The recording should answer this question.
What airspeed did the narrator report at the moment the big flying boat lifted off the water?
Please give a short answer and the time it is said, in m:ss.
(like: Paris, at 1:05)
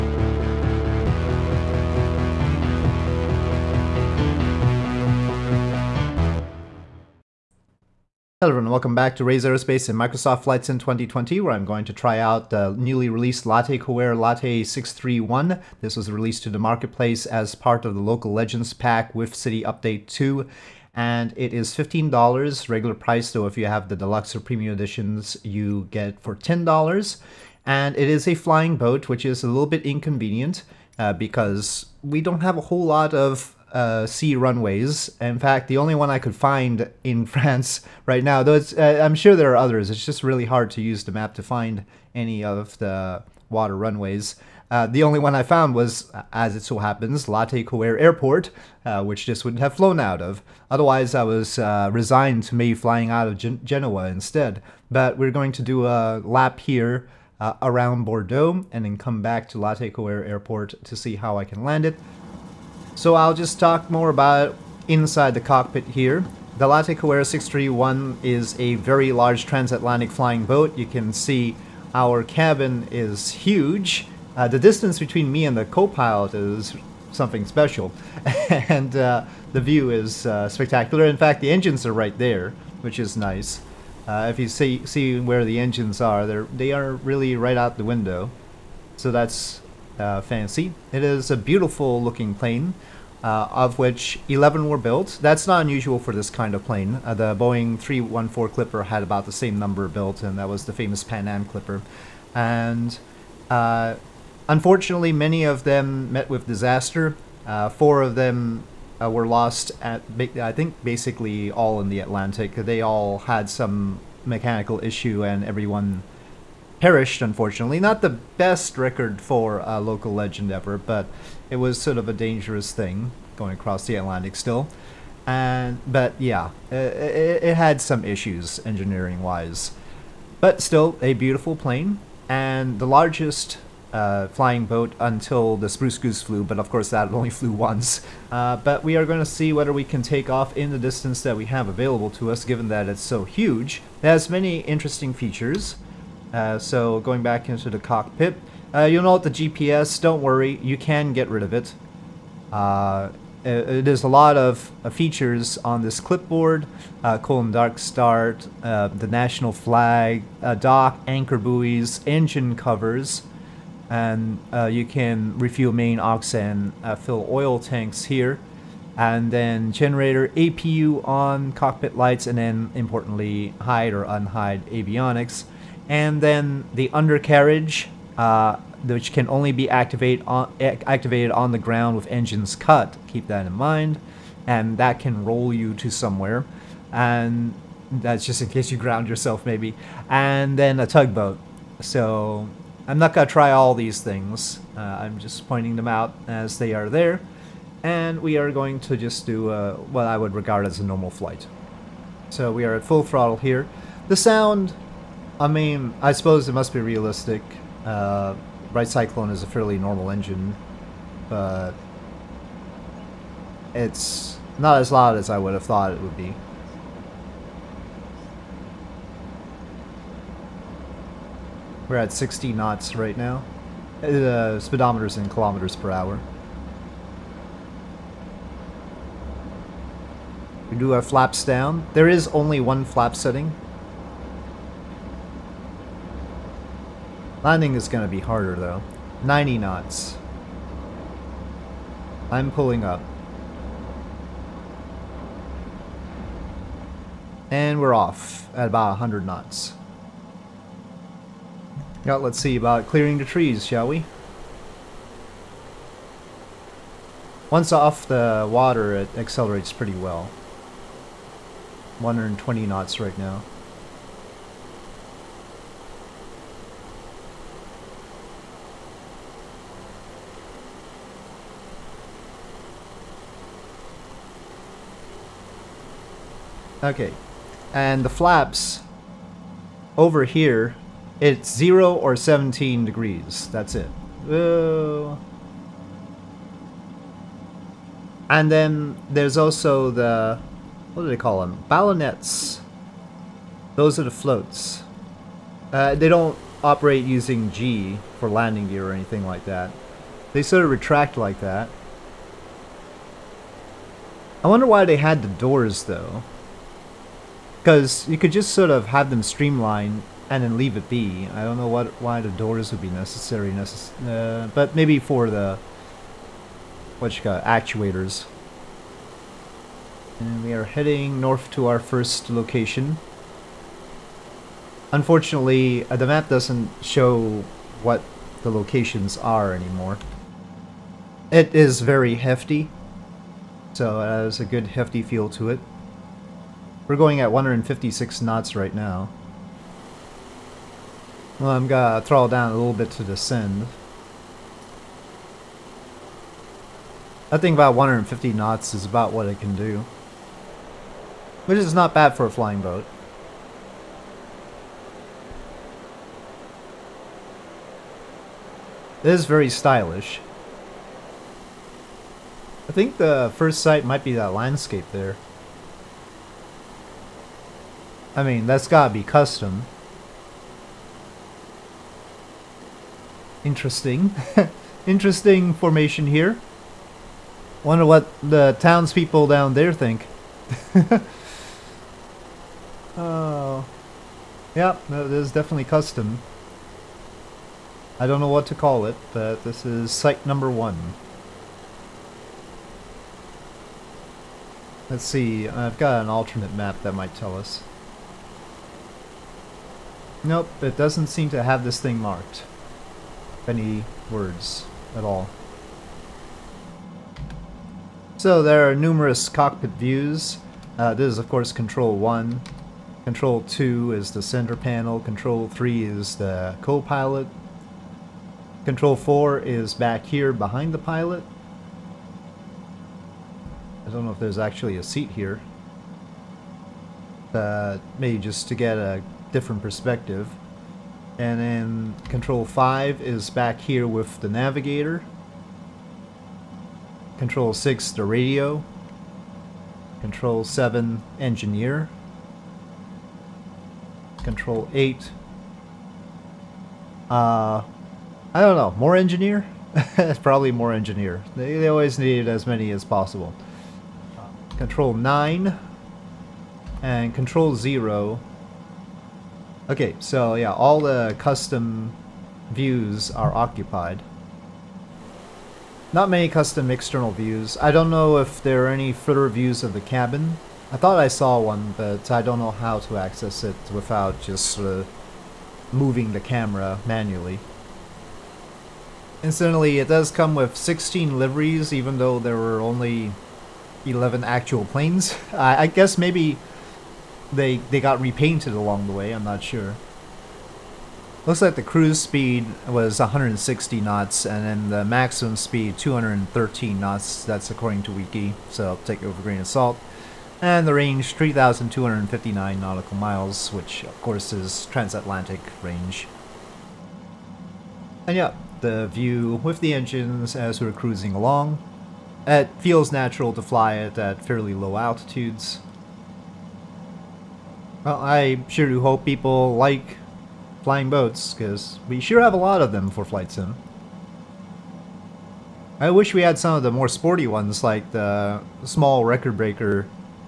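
100 knots, at 4:08.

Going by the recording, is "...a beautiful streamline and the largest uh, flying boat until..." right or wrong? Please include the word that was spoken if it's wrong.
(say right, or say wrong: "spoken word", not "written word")
wrong: "plane", not "streamline".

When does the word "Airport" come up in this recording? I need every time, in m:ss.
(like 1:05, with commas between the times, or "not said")
0:47, 1:00.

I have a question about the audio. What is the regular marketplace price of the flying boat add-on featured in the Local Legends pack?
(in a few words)
$15.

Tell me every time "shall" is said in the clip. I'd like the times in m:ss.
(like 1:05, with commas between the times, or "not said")
4:13.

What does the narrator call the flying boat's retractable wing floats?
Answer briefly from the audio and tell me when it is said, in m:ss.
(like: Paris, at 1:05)
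Ballonets, at 4:51.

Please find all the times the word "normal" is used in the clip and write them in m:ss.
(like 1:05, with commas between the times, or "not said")
3:20, 3:29.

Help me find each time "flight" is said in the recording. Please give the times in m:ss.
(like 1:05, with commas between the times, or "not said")
0:10, 3:21, 8:43.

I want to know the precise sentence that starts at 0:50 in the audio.
Otherwise, I was uh, resigned to me flying out of Gen Genoa instead.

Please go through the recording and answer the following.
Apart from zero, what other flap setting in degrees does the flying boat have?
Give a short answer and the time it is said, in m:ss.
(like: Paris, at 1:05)
17 degrees, at 4:42.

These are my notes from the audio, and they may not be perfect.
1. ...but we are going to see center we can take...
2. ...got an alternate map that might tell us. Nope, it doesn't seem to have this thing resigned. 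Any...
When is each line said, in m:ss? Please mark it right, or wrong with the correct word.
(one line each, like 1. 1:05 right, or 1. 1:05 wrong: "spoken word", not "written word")
1. 2:18 wrong: "whether", not "center"
2. 6:35 wrong: "marked", not "resigned".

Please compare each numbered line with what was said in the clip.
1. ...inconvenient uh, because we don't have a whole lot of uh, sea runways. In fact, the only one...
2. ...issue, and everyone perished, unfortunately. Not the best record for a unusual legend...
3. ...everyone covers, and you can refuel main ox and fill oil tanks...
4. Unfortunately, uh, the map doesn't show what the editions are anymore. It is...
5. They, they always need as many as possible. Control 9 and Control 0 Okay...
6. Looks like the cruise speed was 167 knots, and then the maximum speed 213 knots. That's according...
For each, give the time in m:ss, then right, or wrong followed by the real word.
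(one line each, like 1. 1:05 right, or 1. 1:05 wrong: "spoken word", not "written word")
1. 0:29 right
2. 1:54 wrong: "local", not "unusual"
3. 2:42 wrong: "engine", not "everyone"
4. 5:24 wrong: "locations", not "editions"
5. 7:31 right
6. 8:11 wrong: "160", not "167".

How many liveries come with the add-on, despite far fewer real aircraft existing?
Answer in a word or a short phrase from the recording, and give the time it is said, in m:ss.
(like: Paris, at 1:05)
16, at 8:00.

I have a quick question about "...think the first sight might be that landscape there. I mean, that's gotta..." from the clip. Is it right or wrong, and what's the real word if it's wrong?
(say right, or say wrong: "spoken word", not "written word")
right.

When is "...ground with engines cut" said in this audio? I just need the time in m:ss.
3:01.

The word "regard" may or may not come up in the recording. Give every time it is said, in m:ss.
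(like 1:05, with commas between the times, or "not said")
3:20.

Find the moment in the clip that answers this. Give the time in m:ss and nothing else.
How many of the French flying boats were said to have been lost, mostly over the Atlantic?
1:47.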